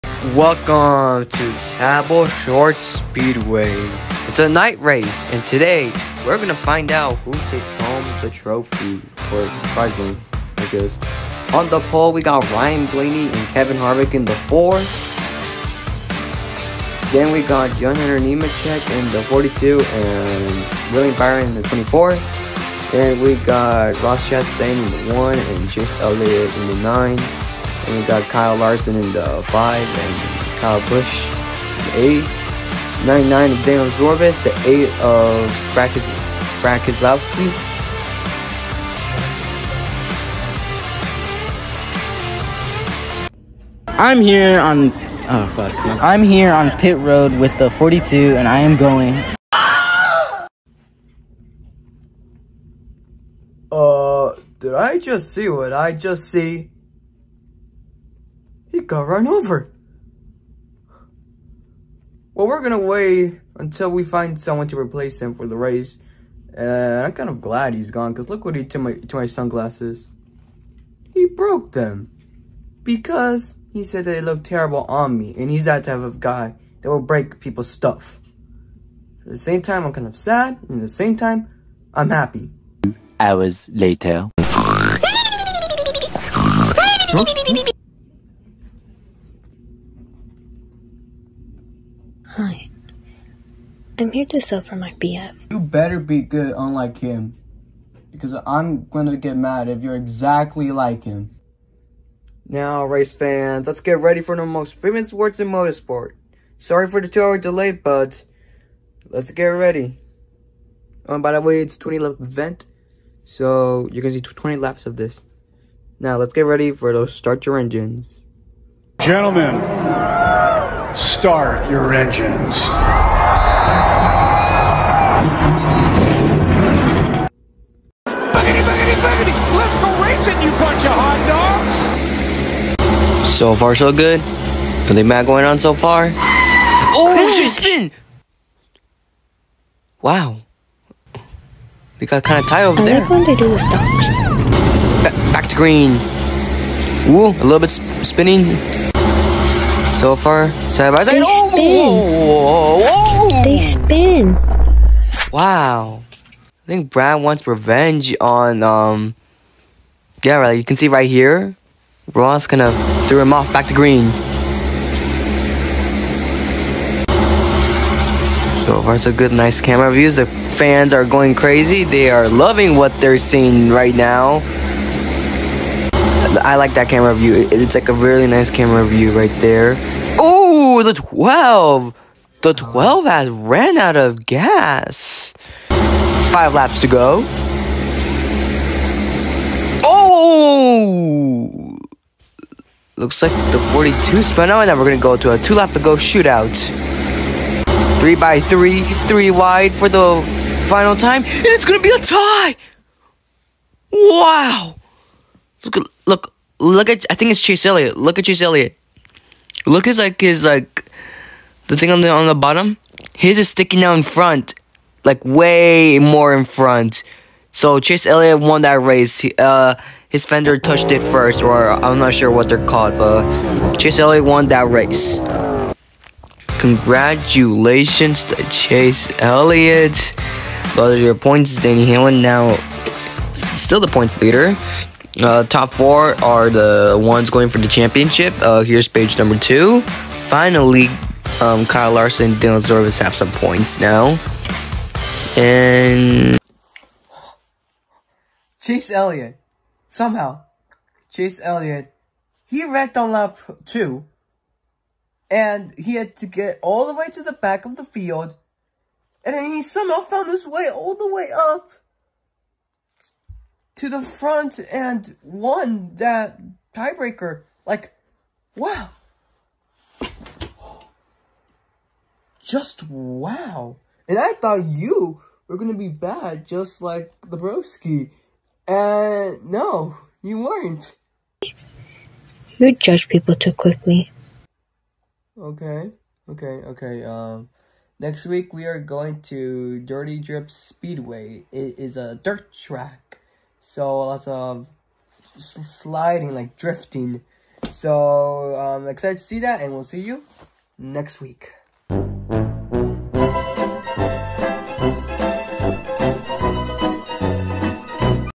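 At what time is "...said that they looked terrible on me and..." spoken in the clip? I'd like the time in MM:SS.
01:13.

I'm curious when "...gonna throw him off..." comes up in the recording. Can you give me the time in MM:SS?
02:42.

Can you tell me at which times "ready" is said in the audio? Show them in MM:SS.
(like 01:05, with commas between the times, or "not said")
01:43, 01:49, 01:56.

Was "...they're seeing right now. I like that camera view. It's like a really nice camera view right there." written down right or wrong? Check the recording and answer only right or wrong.
right.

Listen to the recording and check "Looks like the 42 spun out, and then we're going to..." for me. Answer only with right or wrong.
right.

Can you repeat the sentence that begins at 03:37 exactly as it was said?
So Chase Elliott won that race.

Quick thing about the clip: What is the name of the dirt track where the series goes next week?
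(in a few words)
Dirty Drip Speedway.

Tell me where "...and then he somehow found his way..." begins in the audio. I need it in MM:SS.
04:19.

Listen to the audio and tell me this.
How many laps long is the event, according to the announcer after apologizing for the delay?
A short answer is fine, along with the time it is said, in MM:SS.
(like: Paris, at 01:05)
20, at 01:51.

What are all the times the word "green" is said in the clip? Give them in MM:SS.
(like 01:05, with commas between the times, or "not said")
02:25, 02:43.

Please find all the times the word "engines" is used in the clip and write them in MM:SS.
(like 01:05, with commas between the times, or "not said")
01:57, 02:01.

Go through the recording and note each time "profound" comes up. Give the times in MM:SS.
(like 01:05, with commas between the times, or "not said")
not said.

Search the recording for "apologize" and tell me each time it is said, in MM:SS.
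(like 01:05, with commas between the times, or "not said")
not said.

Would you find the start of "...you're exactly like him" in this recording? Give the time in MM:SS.
01:39.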